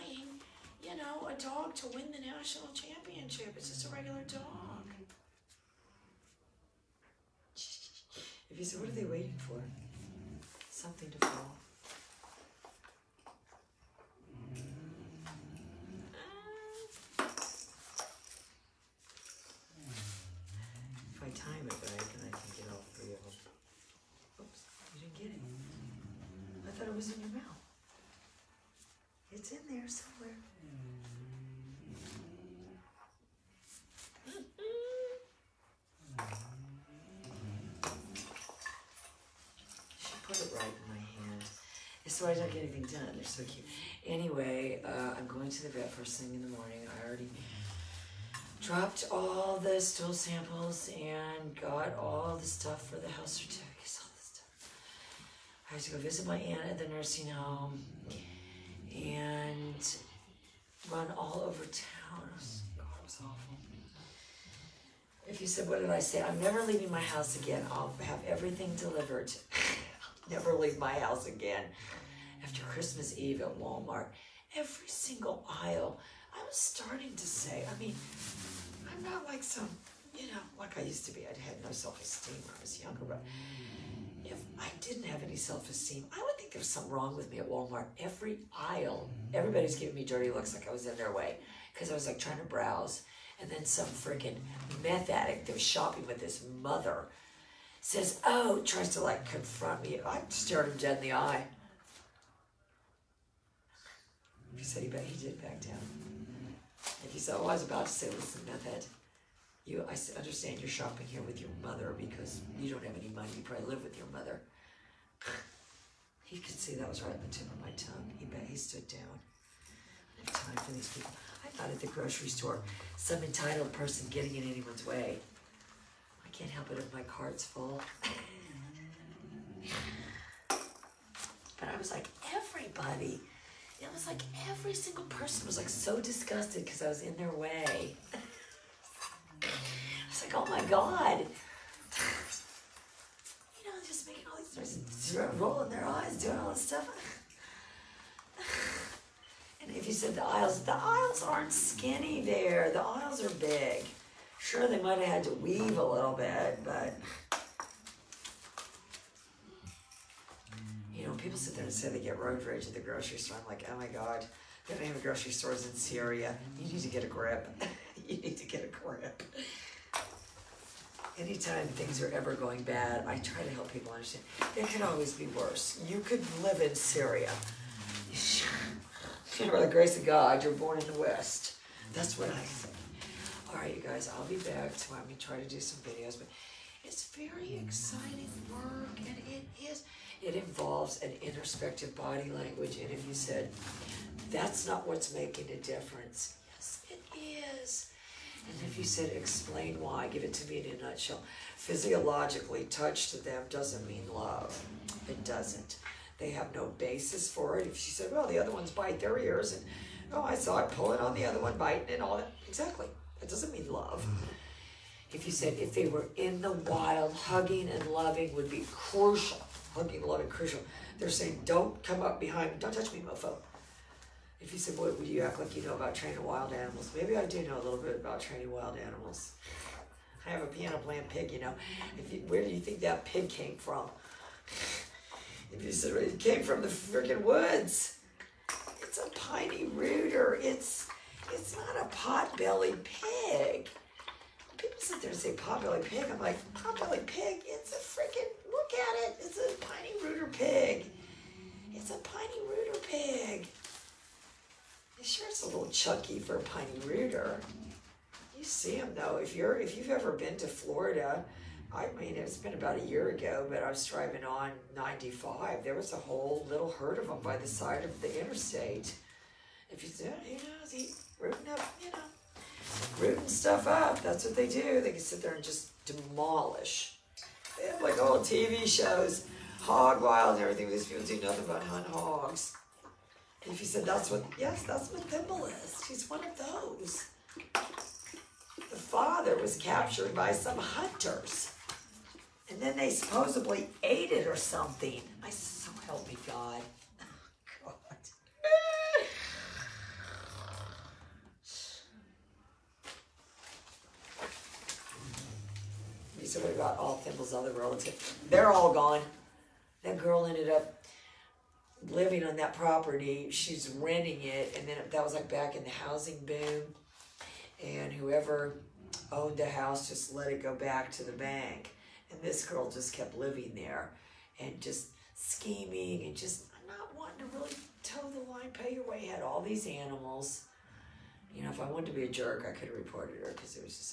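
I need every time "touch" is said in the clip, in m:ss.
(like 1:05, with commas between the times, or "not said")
3:22, 3:42.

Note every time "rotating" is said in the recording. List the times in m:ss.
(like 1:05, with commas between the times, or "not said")
not said.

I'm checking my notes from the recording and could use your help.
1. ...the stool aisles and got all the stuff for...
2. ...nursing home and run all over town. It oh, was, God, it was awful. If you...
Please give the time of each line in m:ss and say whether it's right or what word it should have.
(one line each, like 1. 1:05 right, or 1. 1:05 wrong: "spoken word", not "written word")
1. 0:49 wrong: "samples", not "aisles"
2. 0:56 right.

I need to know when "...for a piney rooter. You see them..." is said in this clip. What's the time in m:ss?
4:16.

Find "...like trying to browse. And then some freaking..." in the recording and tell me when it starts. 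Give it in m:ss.
1:32.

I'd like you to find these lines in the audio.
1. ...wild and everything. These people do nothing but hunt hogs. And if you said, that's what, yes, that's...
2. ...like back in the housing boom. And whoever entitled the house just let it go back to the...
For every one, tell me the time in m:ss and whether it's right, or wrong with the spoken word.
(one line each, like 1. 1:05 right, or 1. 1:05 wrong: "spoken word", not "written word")
1. 4:40 right
2. 5:15 wrong: "owned", not "entitled".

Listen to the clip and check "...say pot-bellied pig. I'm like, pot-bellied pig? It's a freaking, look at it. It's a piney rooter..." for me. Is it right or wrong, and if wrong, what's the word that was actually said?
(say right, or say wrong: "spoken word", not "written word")
right.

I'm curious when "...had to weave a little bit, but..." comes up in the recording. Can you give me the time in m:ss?
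2:35.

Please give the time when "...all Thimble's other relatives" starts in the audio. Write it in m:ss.
5:06.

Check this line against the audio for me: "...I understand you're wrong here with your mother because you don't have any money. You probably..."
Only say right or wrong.
wrong.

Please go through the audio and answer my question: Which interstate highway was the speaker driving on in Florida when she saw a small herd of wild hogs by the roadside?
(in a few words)
95.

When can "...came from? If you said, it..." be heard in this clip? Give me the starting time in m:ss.
3:53.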